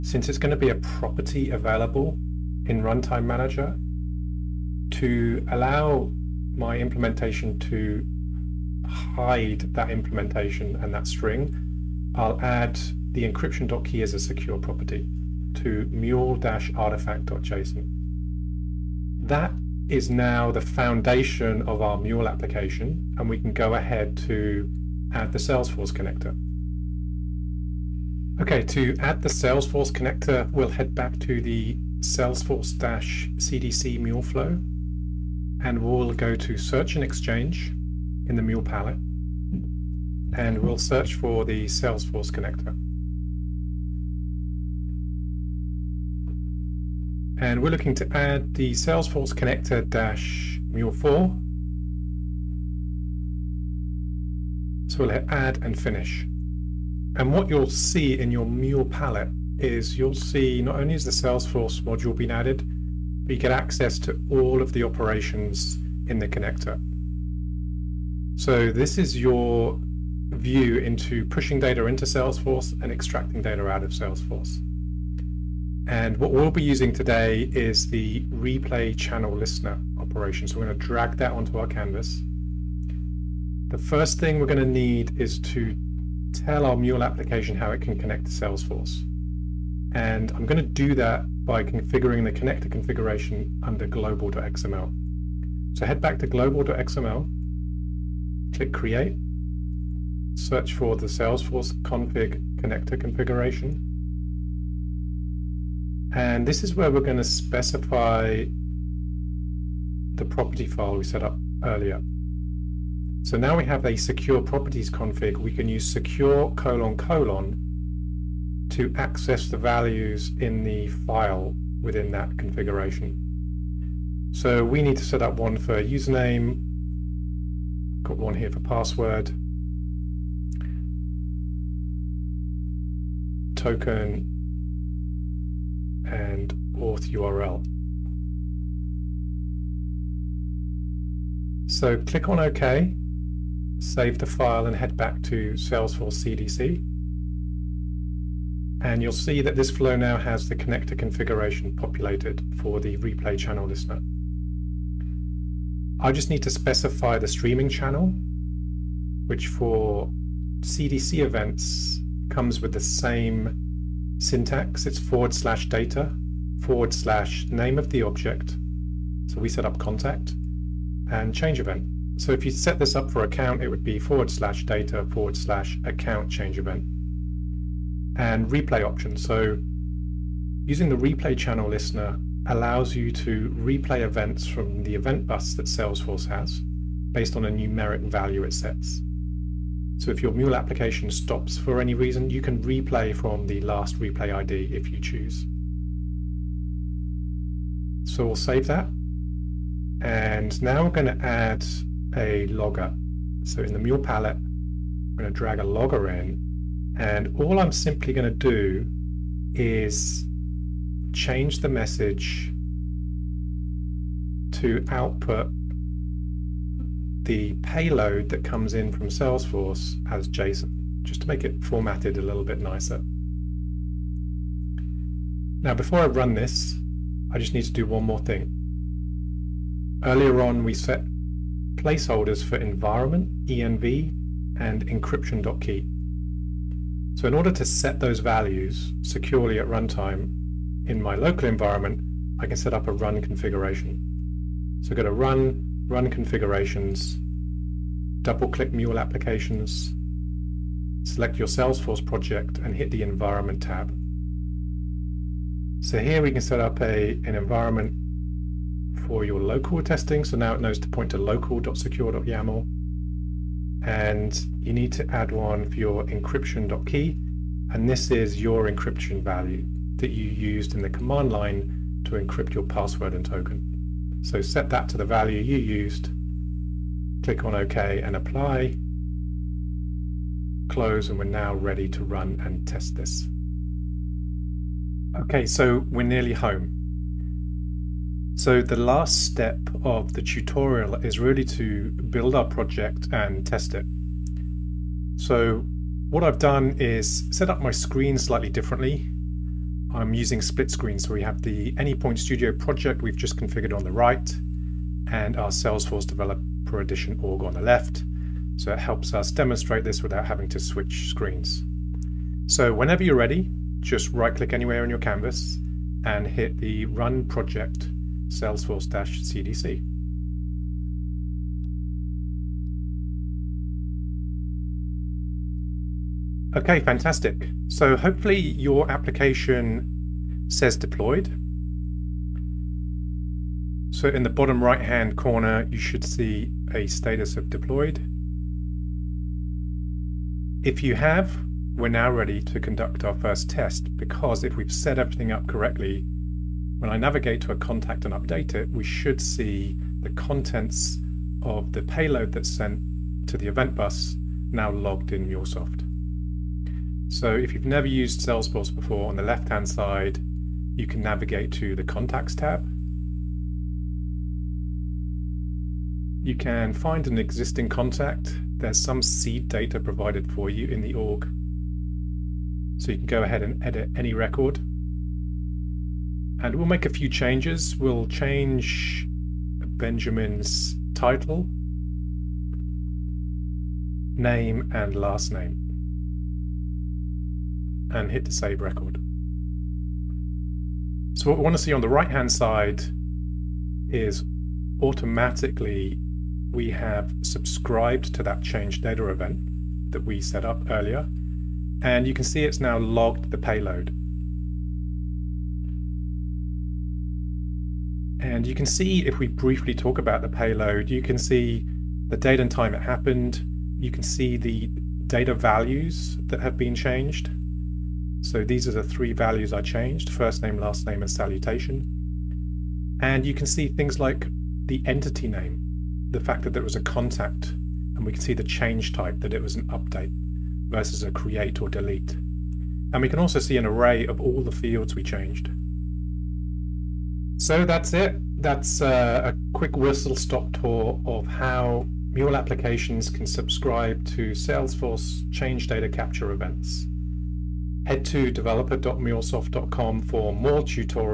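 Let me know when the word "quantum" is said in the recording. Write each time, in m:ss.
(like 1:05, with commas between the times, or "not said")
not said.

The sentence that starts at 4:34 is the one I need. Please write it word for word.
So set that to the value you used.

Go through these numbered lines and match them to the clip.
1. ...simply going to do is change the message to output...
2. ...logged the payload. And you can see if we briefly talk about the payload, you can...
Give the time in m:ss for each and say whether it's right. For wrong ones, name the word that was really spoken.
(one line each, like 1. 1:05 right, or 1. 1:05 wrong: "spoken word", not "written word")
1. 3:27 right
2. 6:42 right.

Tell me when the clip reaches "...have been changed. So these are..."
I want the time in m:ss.
6:56.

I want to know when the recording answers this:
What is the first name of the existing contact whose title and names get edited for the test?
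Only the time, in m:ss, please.
6:19.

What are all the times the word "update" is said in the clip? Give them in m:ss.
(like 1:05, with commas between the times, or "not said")
5:48, 7:09.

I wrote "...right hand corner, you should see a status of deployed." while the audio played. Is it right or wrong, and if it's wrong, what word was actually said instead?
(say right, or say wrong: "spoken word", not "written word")
right.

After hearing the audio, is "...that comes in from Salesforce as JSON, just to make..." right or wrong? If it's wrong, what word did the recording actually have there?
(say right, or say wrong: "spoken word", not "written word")
right.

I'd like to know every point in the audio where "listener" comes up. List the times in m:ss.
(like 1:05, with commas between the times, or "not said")
1:19, 2:33, 3:01.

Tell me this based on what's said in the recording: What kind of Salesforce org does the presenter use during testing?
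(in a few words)
Developer Edition.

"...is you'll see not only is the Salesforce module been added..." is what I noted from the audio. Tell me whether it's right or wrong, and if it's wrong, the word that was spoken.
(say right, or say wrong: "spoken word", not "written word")
right.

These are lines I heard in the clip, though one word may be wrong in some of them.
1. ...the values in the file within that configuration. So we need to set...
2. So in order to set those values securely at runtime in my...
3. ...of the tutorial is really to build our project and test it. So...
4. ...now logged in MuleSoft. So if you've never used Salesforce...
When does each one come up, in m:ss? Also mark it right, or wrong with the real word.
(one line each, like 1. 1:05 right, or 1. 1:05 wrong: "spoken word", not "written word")
1. 1:59 right
2. 3:57 right
3. 4:49 right
4. 5:54 right.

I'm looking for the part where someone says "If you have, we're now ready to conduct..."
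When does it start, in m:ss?
5:40.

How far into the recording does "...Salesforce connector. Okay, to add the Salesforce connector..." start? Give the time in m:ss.
0:25.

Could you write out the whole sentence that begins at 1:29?
And I'm going to do that by configuring the connector configuration under global.xml.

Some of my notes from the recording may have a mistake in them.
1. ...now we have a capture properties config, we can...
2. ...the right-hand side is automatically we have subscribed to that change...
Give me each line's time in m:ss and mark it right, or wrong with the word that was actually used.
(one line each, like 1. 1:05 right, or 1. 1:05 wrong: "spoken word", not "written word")
1. 1:53 wrong: "secure", not "capture"
2. 6:31 right.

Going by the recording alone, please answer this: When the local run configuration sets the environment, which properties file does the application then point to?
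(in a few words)
local.secure.yaml.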